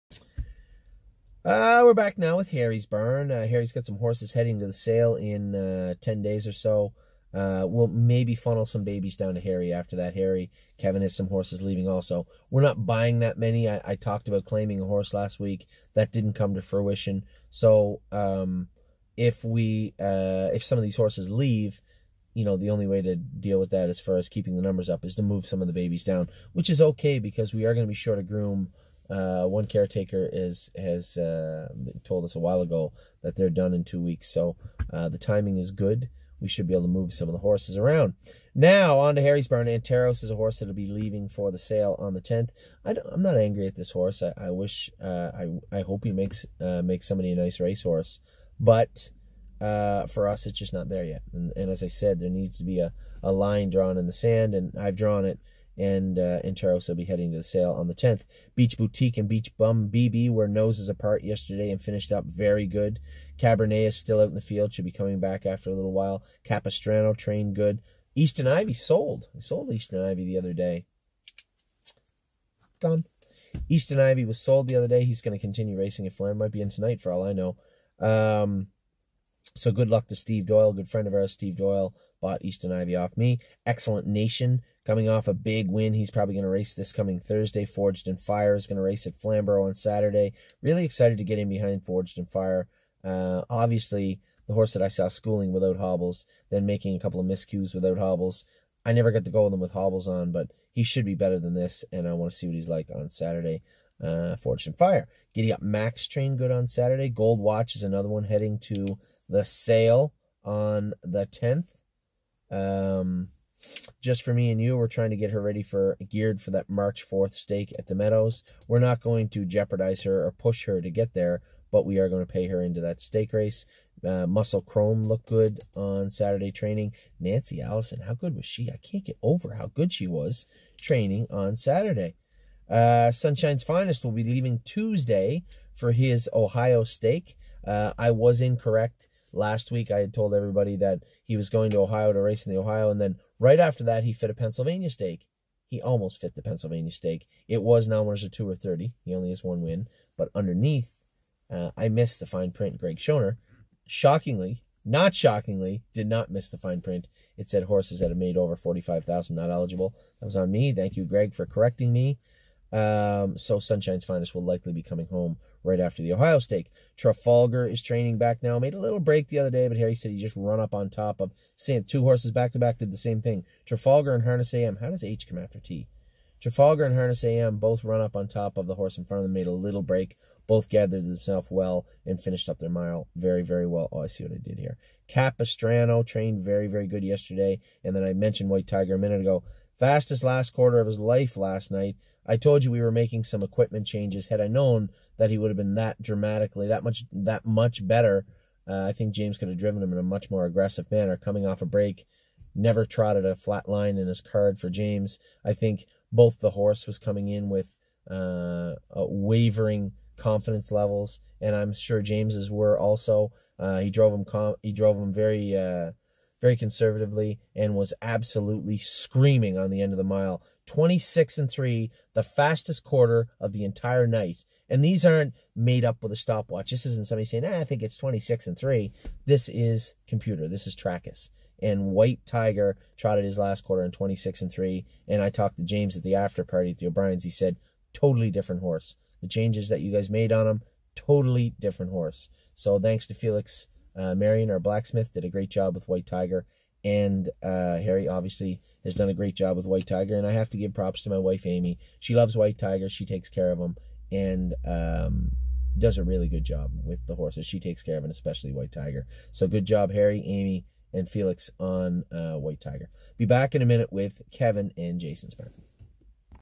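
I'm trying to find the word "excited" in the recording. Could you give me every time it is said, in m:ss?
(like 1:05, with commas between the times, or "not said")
1:30.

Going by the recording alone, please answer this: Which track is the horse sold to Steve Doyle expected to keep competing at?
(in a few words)
Flanders.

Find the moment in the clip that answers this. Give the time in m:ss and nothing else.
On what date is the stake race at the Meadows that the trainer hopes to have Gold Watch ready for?
1:56.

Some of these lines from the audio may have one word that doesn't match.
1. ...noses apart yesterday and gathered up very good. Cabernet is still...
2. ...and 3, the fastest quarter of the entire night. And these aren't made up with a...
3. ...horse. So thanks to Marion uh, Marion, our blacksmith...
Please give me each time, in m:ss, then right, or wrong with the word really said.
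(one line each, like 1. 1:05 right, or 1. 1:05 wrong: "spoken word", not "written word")
1. 1:00 wrong: "finished", not "gathered"
2. 3:41 right
3. 4:01 wrong: "Felix", not "Marion".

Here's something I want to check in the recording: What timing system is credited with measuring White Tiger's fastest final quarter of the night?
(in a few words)
Trakus.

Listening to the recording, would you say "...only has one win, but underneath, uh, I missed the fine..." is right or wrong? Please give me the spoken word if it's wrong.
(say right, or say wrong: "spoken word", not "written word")
right.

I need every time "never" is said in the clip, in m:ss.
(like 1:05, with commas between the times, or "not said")
1:38, 3:22.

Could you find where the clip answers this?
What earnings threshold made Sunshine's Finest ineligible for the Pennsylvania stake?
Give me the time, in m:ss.
2:38.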